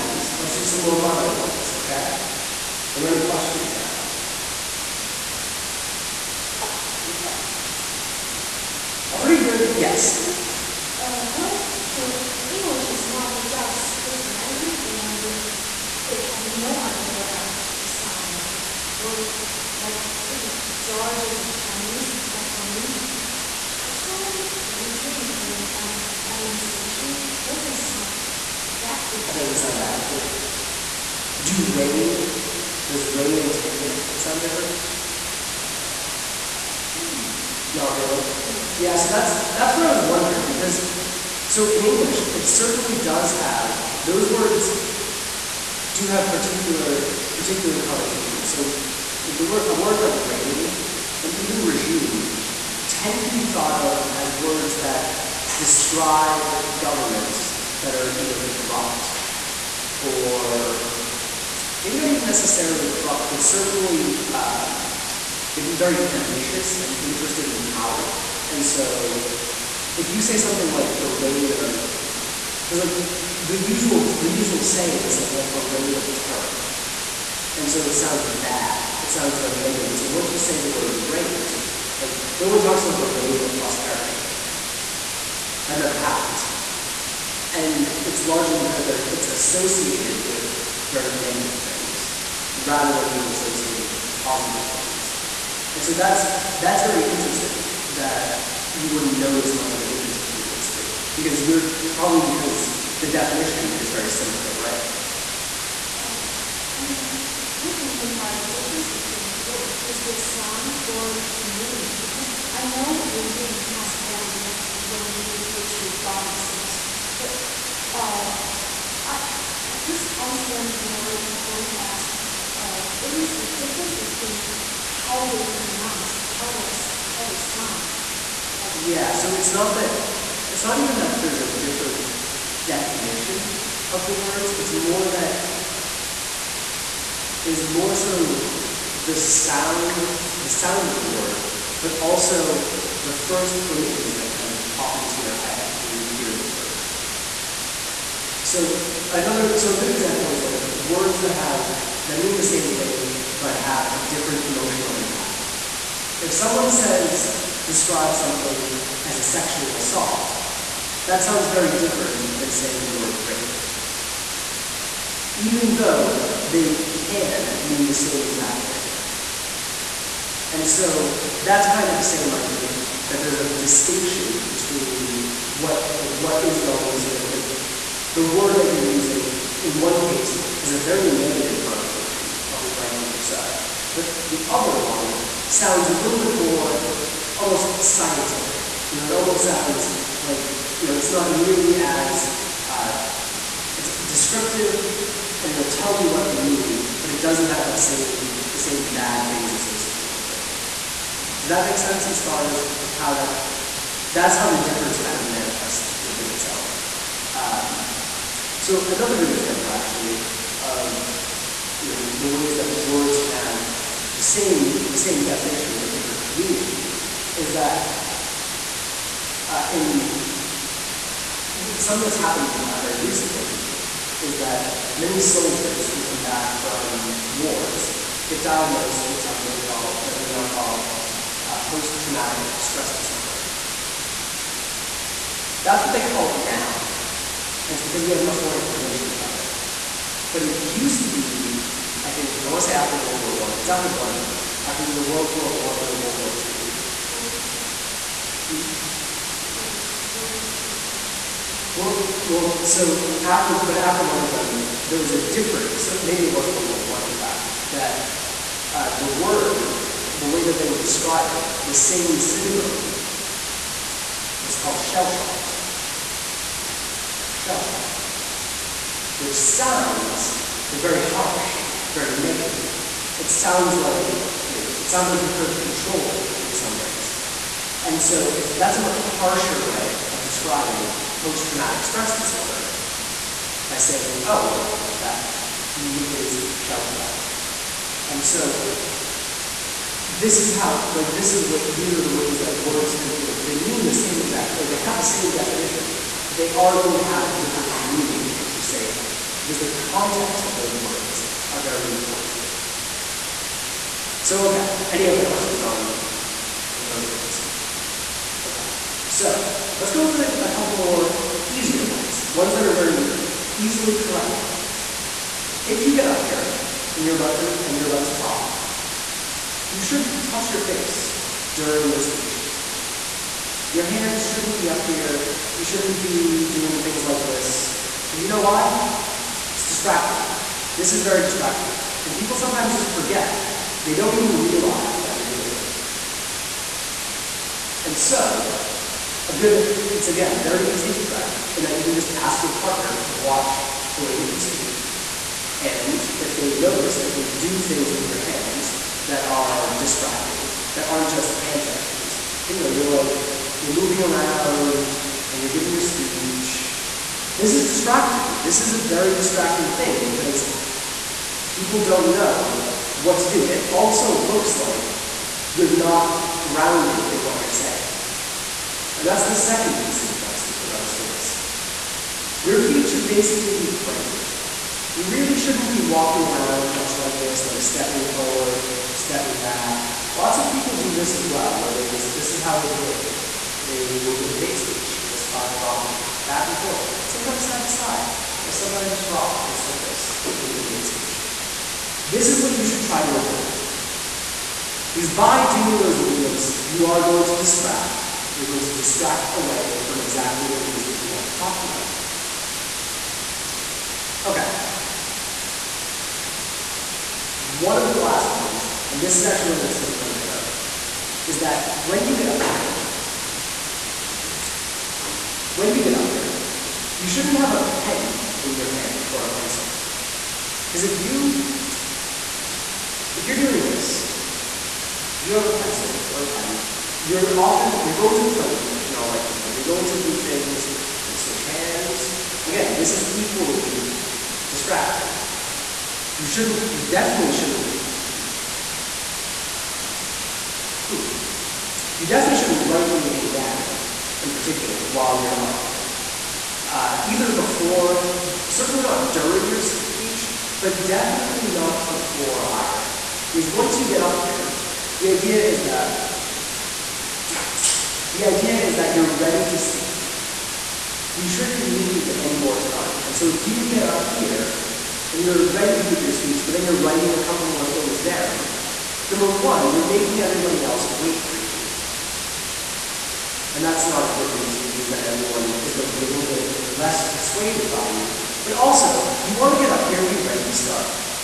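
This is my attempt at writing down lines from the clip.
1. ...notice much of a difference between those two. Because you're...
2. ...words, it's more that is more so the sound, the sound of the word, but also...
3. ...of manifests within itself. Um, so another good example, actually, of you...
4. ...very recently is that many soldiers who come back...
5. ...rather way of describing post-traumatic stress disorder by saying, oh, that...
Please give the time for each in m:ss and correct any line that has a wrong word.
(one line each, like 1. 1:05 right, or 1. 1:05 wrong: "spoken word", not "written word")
1. 1:39 right
2. 2:14 right
3. 3:25 right
4. 3:42 right
5. 4:39 wrong: "harsher", not "rather".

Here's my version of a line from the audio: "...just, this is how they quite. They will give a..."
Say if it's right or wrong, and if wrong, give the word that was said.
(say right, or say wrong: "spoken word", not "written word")
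wrong: "debate", not "quite".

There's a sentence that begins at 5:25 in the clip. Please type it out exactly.
You shouldn't be doing things like this.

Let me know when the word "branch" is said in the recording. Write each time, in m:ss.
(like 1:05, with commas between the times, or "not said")
not said.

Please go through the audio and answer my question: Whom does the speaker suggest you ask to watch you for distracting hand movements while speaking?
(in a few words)
your partner.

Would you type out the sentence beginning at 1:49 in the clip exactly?
Is there sound or the meaning?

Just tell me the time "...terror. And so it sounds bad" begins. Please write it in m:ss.
1:16.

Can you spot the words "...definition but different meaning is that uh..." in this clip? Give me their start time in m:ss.
3:35.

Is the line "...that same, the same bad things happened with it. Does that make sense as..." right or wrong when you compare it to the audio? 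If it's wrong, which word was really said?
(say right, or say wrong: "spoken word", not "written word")
wrong: "associated", not "happened".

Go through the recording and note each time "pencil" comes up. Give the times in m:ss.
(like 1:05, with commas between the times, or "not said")
6:59, 7:05.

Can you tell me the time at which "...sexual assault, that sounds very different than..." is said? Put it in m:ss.
2:39.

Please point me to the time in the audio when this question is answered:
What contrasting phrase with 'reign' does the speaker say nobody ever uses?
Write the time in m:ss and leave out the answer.
1:23.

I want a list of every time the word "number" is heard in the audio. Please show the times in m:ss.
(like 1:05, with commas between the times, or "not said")
7:49.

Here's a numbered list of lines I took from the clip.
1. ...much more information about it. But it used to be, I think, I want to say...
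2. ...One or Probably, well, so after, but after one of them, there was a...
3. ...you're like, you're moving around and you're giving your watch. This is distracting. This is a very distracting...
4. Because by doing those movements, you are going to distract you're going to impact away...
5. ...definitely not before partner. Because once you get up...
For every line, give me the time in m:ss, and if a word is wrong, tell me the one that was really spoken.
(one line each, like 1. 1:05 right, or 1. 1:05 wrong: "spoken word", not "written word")
1. 3:58 right
2. 4:05 wrong: "Well", not "Probably"
3. 5:52 wrong: "speech", not "watch"
4. 6:34 wrong: "distract", not "impact"
5. 7:30 wrong: "either", not "partner".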